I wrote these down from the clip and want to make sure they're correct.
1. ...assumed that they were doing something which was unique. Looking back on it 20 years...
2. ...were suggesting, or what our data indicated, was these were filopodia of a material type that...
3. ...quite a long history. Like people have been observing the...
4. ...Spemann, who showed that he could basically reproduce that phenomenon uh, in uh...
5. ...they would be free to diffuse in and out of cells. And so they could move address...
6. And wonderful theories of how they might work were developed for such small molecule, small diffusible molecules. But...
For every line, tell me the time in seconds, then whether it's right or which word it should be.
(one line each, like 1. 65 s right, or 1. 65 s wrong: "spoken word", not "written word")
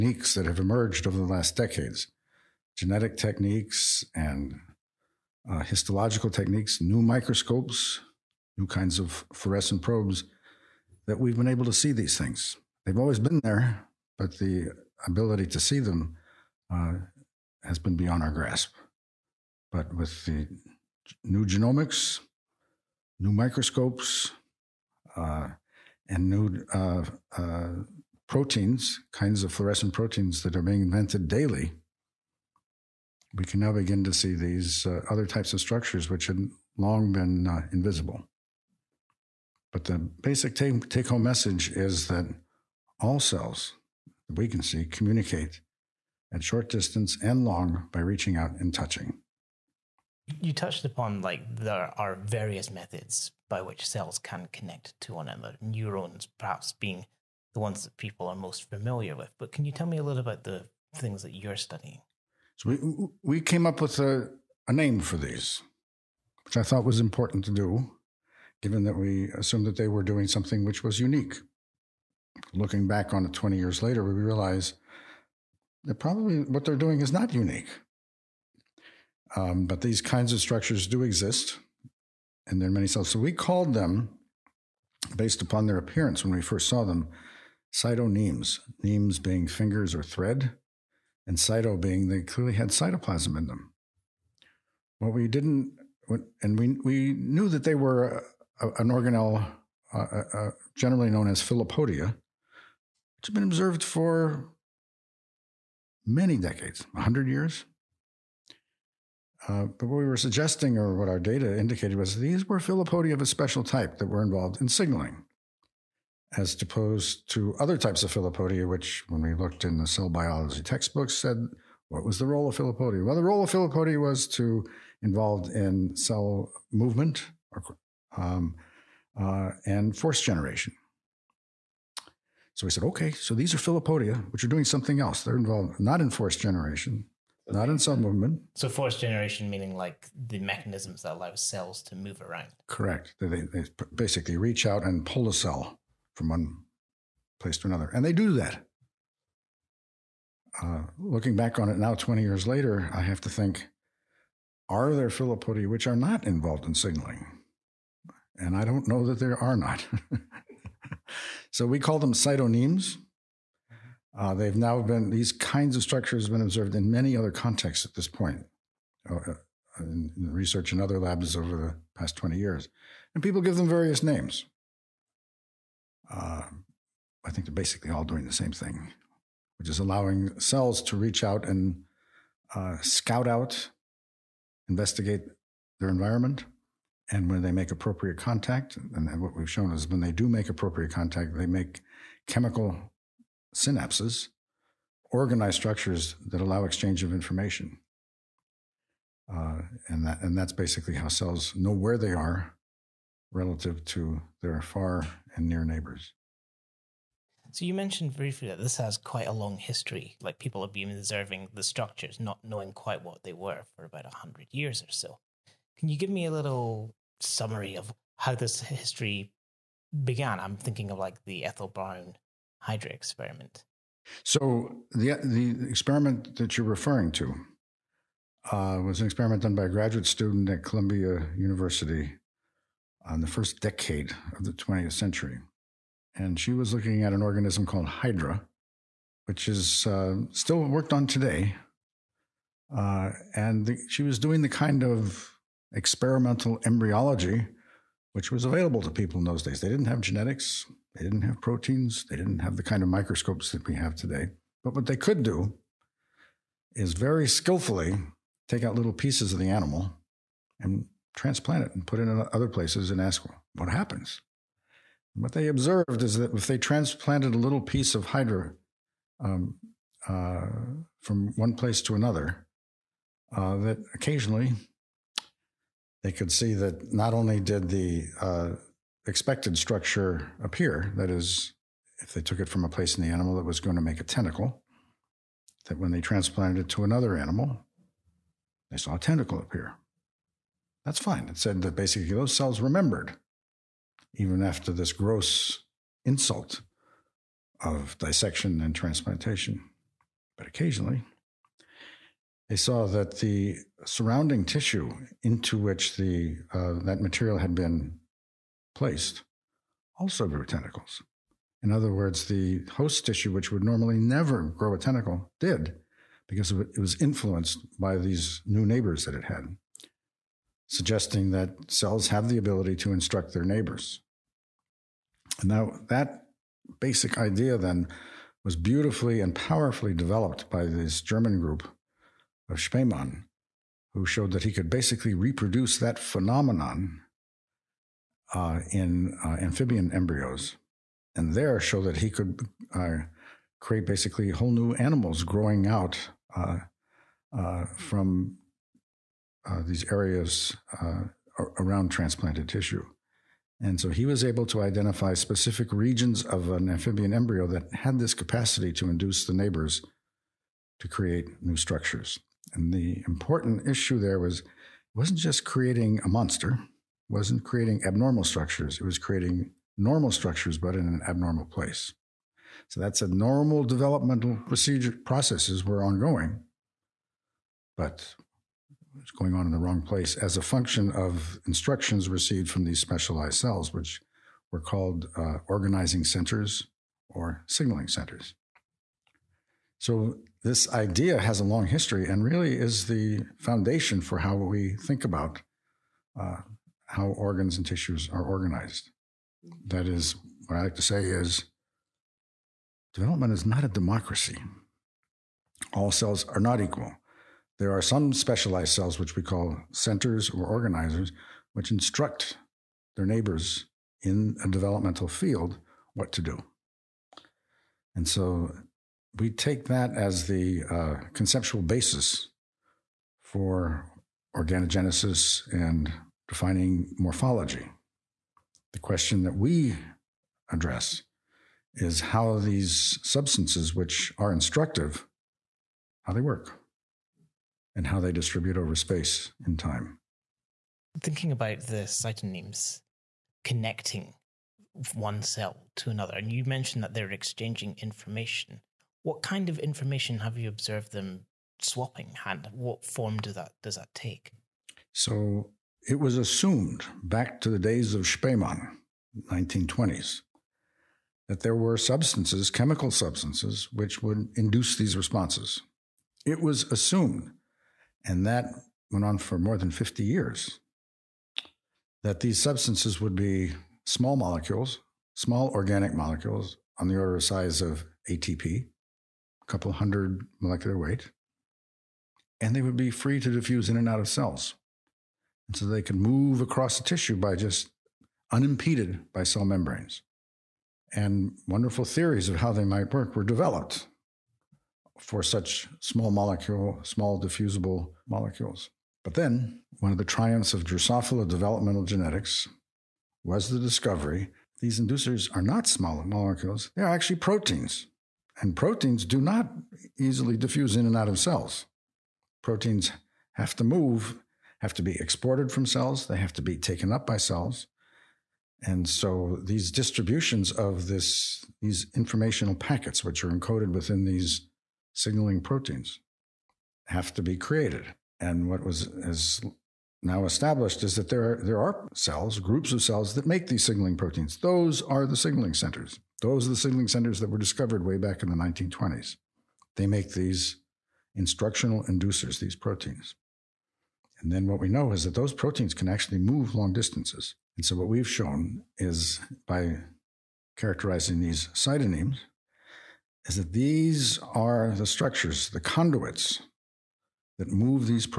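1. 69 s right
2. 110 s wrong: "special", not "material"
3. 208 s right
4. 332 s right
5. 482 s wrong: "across", not "address"
6. 490 s right.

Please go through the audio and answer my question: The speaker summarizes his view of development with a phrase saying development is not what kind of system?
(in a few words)
a democracy.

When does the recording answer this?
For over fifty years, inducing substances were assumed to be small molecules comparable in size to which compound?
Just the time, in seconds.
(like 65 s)
478 s.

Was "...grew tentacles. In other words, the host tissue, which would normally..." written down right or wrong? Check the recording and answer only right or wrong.
right.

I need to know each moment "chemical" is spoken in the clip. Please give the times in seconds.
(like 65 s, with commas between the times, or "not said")
192 s, 462 s.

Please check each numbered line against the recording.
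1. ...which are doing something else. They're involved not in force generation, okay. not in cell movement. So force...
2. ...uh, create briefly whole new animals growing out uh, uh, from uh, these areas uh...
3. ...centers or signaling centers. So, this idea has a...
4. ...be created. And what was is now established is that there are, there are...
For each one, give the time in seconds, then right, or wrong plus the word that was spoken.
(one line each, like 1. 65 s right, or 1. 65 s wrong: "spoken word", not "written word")
1. 134 s right
2. 342 s wrong: "basically", not "briefly"
3. 386 s right
4. 527 s right.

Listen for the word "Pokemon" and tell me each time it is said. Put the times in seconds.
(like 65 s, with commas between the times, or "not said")
not said.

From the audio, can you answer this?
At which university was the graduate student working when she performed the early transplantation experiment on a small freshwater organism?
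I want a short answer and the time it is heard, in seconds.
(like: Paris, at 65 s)
Columbia University, at 230 s.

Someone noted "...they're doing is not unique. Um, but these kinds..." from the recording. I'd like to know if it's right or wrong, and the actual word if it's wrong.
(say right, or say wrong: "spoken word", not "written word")
right.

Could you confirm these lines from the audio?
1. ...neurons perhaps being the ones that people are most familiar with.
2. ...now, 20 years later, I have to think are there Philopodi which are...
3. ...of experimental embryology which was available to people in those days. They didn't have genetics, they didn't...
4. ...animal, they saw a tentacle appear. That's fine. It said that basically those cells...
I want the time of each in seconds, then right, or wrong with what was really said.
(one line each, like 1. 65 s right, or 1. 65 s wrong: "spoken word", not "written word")
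1. 55 s right
2. 151 s right
3. 244 s right
4. 287 s right.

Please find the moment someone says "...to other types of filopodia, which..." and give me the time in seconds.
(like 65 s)
117 s.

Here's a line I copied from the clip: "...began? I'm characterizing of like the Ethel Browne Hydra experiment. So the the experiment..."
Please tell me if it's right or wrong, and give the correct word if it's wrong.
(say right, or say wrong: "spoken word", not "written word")
wrong: "thinking", not "characterizing".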